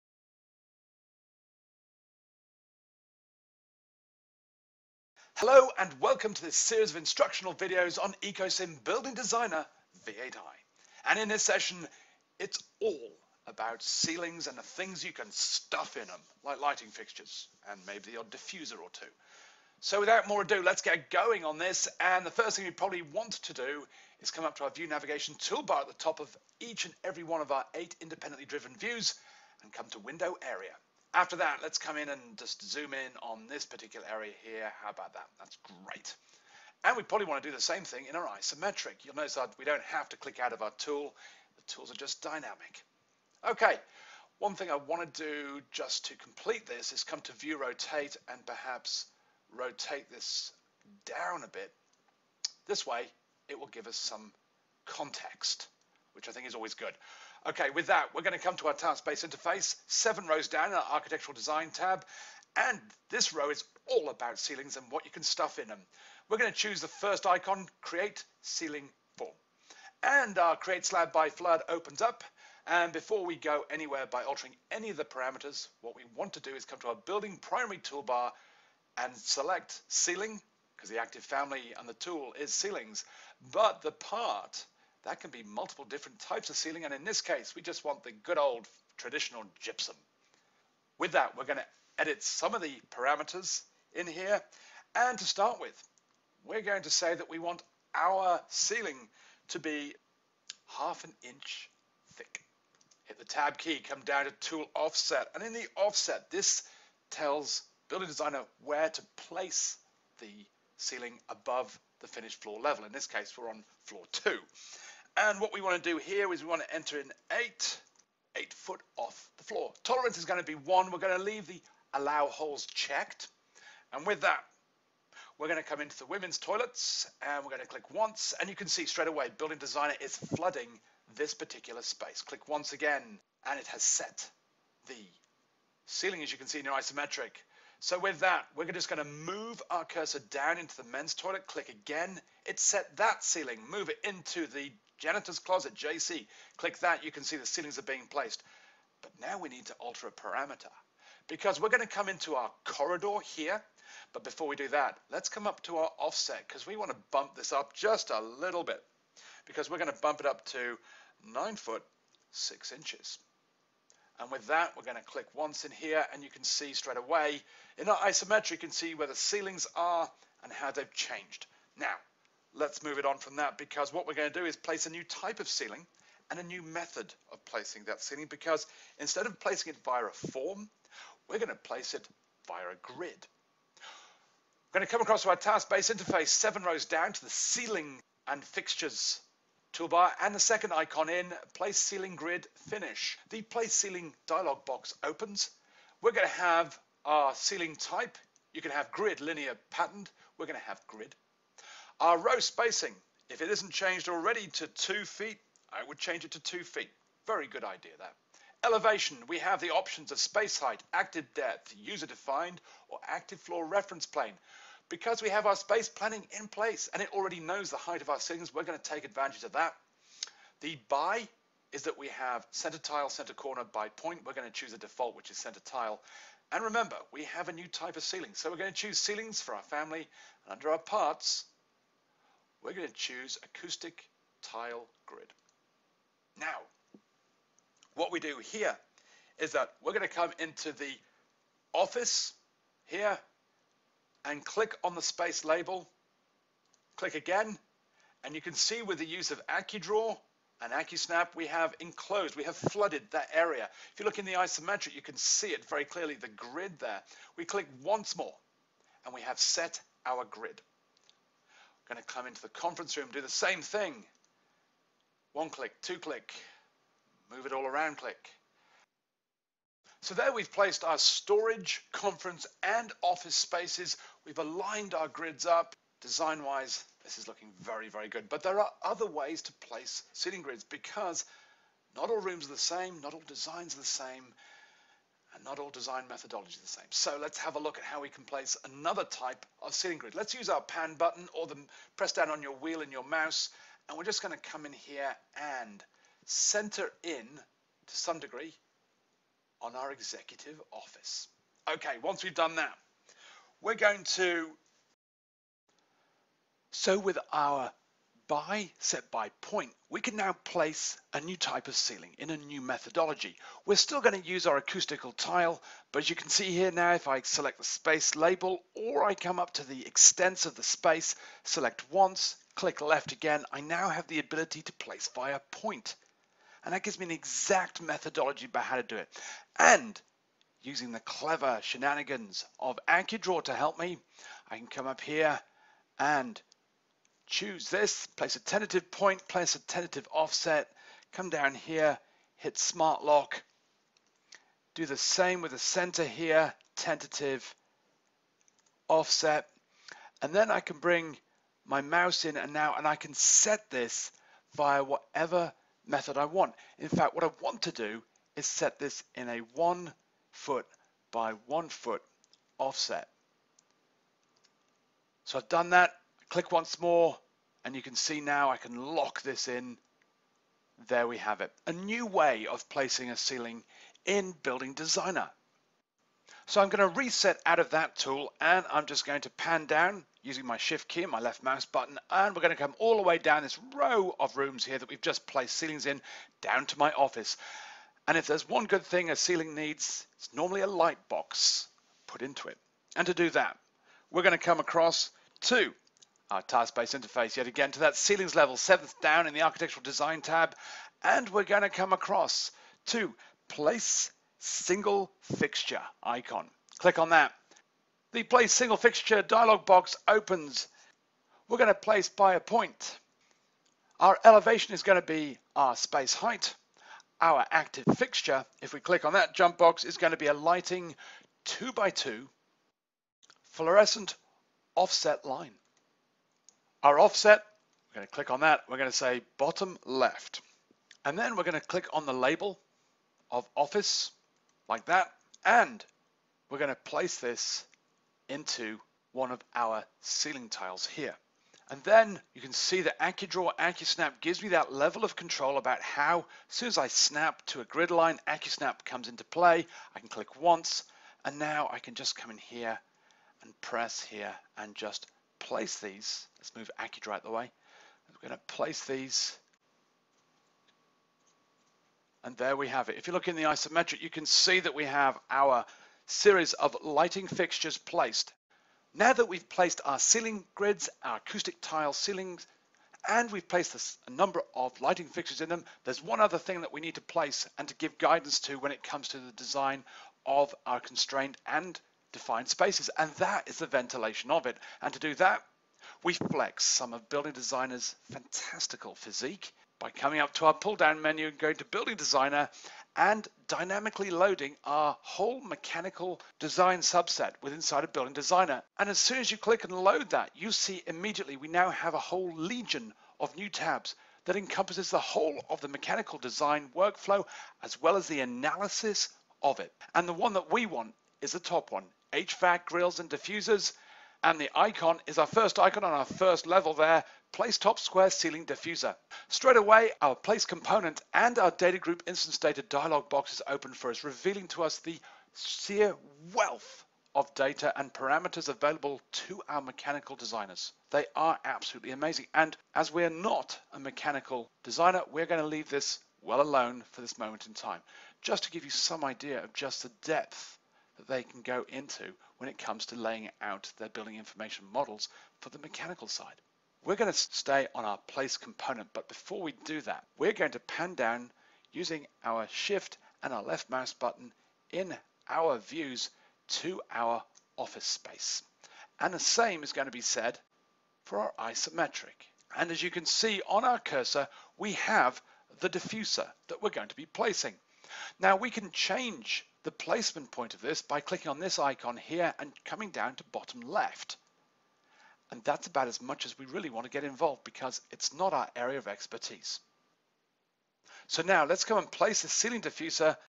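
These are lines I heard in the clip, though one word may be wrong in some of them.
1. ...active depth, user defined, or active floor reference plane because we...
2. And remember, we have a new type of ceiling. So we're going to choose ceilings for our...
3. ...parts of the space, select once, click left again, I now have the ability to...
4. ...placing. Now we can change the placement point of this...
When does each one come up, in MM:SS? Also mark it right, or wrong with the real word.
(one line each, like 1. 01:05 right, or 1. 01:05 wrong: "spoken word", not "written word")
1. 03:30 right
2. 03:46 right
3. 05:19 wrong: "extents", not "parts"
4. 09:27 right.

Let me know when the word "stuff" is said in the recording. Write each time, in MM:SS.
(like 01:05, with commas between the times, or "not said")
00:15, 01:05.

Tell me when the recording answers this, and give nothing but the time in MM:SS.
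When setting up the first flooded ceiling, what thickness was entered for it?
01:40.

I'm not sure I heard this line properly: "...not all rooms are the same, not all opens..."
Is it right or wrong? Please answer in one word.
wrong.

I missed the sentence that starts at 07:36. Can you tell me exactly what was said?
Let's move AccuDraw out the way.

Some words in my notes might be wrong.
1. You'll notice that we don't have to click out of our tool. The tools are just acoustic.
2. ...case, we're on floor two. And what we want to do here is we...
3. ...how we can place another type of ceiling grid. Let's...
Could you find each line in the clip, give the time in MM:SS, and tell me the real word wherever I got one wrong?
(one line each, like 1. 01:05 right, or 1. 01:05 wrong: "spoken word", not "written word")
1. 00:39 wrong: "dynamic", not "acoustic"
2. 01:53 right
3. 04:47 right.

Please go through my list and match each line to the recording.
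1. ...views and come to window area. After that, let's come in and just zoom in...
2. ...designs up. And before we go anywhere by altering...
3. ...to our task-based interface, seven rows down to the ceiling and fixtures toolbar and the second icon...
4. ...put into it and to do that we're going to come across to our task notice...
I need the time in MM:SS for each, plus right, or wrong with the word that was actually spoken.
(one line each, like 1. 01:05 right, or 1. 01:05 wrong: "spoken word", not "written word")
1. 00:28 right
2. 01:11 wrong: "opens", not "designs"
3. 03:05 right
4. 06:32 wrong: "space", not "notice".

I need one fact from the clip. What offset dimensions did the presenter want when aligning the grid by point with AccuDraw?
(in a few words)
1 foot by 1 foot.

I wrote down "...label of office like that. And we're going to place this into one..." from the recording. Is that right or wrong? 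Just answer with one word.
right.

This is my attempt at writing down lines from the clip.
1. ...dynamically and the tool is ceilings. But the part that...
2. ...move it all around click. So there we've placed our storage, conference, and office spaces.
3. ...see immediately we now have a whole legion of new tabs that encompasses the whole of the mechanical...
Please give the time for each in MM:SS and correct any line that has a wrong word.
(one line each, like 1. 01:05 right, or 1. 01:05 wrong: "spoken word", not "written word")
1. 01:21 wrong: "family", not "dynamically"
2. 04:27 right
3. 08:20 right.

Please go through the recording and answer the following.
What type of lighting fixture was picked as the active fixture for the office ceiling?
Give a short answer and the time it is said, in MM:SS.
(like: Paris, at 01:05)
2 by 2 fluorescent, at 07:00.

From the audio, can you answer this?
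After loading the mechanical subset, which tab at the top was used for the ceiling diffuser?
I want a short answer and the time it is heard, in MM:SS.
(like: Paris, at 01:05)
HVAC grills and diffusers, at 08:32.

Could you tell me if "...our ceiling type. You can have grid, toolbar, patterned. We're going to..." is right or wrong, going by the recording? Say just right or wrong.
wrong.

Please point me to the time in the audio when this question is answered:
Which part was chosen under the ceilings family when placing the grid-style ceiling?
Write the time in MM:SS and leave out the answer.
03:53.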